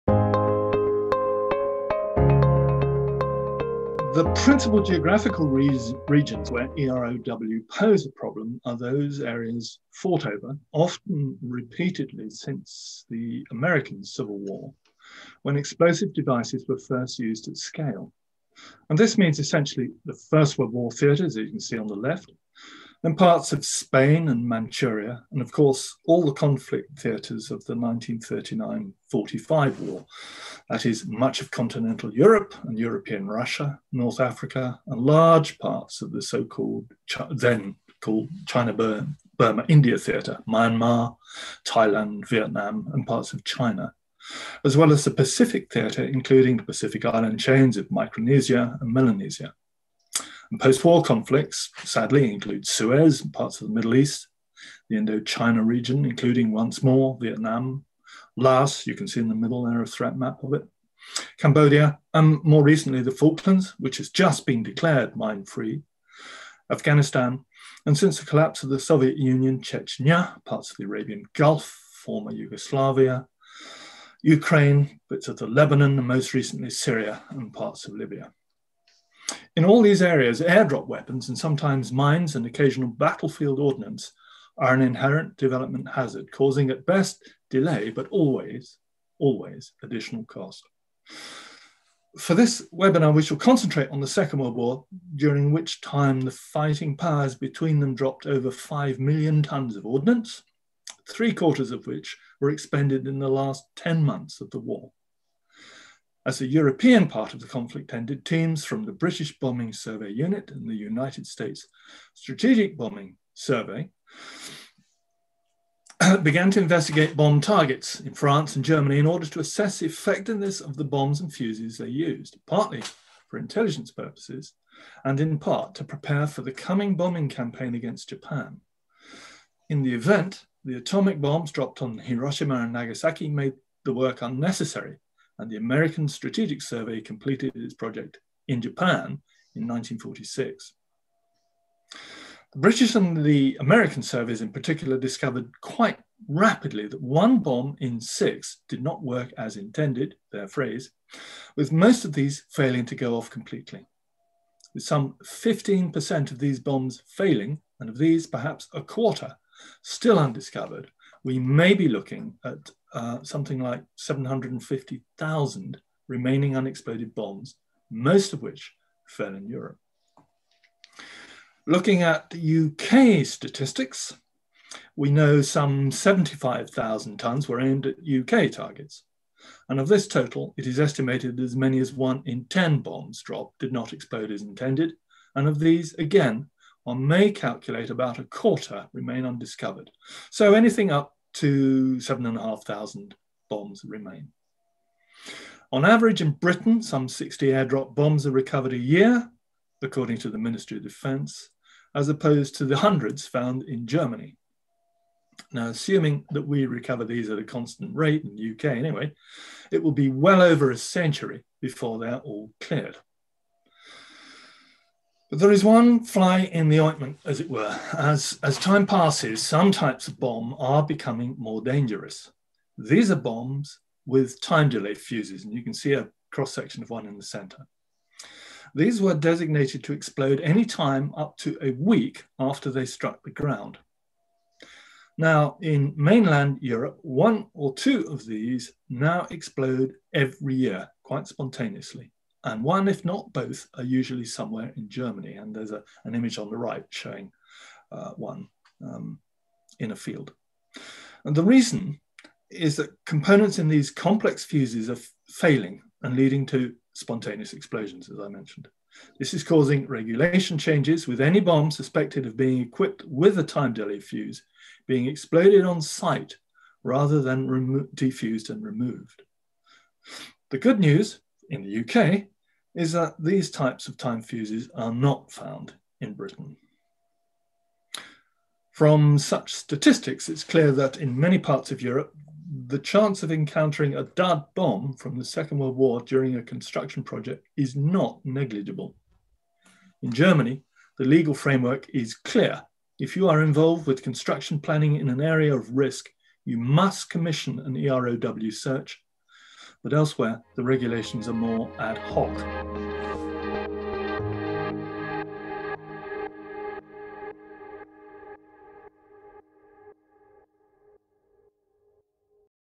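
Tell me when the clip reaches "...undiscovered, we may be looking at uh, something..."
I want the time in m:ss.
2:40.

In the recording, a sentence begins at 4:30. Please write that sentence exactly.
The good news in the UK is that these types of time fuses are not found in Britain.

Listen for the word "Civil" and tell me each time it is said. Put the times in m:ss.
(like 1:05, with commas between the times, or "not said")
0:14.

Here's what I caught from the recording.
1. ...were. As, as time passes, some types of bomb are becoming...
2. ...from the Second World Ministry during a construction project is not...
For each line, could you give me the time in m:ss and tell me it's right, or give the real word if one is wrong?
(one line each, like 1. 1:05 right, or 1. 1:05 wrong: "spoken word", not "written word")
1. 3:37 right
2. 4:44 wrong: "War", not "Ministry".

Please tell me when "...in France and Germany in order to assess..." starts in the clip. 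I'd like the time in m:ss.
1:58.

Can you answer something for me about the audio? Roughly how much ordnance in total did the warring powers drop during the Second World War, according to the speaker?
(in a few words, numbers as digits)
over 5 million tons.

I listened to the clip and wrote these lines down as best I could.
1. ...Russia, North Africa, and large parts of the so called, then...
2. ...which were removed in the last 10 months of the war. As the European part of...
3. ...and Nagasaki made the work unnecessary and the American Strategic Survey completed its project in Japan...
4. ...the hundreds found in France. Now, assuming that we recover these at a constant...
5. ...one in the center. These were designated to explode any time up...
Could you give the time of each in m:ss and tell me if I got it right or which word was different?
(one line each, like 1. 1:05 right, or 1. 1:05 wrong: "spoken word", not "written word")
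1. 0:33 right
2. 1:41 wrong: "expended", not "removed"
3. 2:12 right
4. 3:22 wrong: "Germany", not "France"
5. 3:46 right.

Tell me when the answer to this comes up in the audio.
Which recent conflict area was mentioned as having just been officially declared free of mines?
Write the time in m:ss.
1:03.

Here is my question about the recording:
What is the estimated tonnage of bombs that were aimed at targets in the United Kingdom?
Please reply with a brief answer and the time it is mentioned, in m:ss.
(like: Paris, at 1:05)
75,000 tonnes, at 2:55.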